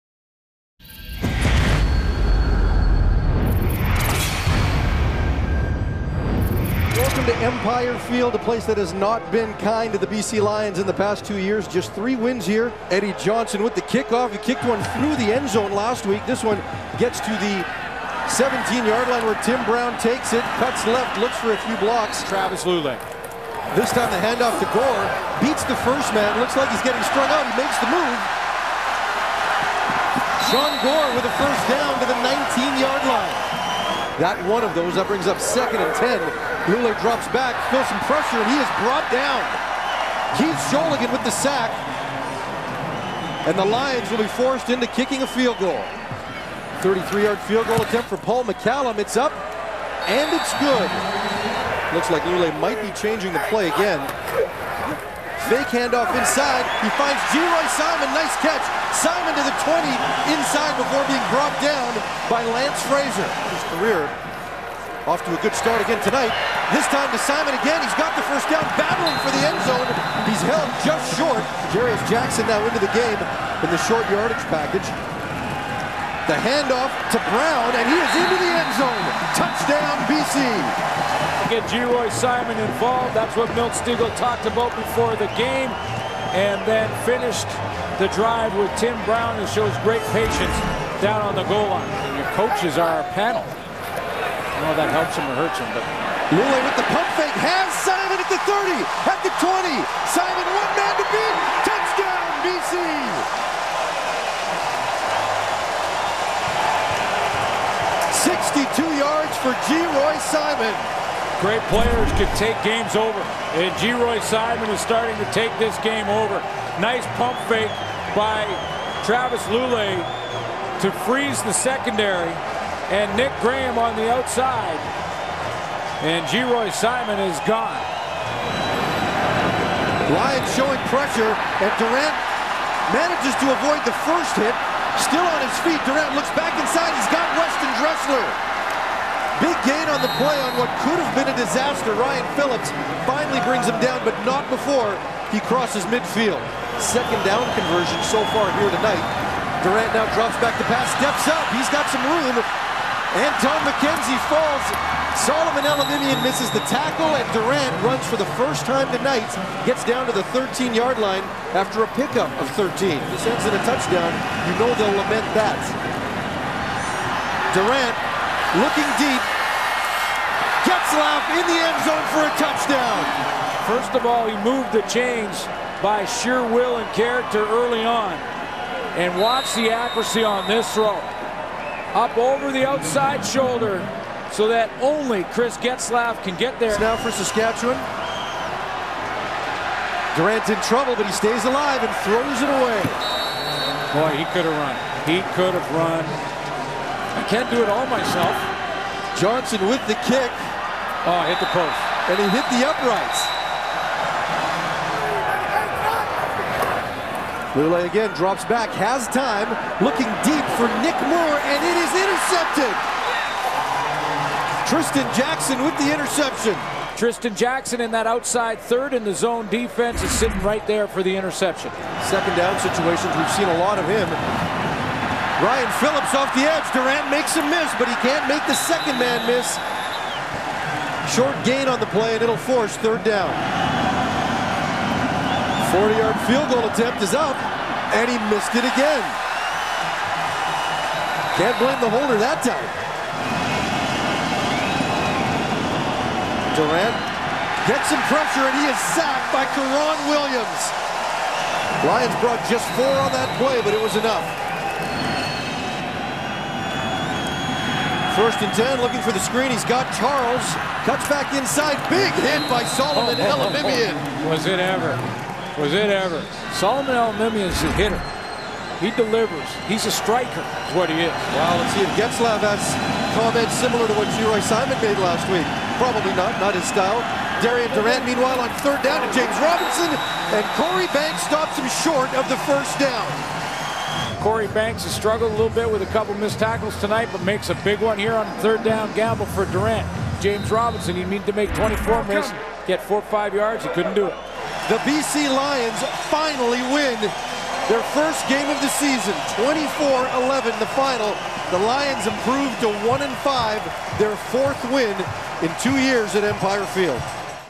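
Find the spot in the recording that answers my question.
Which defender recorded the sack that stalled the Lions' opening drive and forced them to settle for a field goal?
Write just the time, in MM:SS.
00:40.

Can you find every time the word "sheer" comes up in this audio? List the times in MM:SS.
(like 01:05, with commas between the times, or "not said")
02:56.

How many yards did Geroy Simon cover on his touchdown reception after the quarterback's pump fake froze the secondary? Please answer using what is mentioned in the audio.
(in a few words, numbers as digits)
62.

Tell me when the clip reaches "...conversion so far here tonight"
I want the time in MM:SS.
02:27.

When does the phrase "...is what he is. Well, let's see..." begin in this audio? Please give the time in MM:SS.
04:30.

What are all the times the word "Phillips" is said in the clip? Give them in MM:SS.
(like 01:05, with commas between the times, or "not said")
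02:22, 03:45.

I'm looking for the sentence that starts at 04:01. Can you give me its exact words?
Can't blame the holder that time.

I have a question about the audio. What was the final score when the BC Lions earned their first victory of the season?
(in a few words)
24-11.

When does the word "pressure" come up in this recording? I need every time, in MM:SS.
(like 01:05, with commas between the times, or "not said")
00:38, 02:10, 04:08.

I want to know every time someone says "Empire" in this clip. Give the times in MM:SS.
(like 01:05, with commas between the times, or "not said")
00:07, 05:06.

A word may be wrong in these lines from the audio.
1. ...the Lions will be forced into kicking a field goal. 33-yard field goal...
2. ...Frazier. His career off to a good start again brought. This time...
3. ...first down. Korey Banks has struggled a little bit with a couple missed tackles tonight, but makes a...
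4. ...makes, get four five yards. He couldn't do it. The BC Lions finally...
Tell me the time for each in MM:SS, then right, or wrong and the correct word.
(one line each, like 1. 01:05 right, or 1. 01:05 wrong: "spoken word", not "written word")
1. 00:43 right
2. 01:02 wrong: "tonight", not "brought"
3. 04:42 right
4. 04:52 wrong: "misses", not "makes".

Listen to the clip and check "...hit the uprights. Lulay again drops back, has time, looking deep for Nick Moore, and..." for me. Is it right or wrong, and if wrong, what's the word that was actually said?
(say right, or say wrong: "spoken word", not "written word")
right.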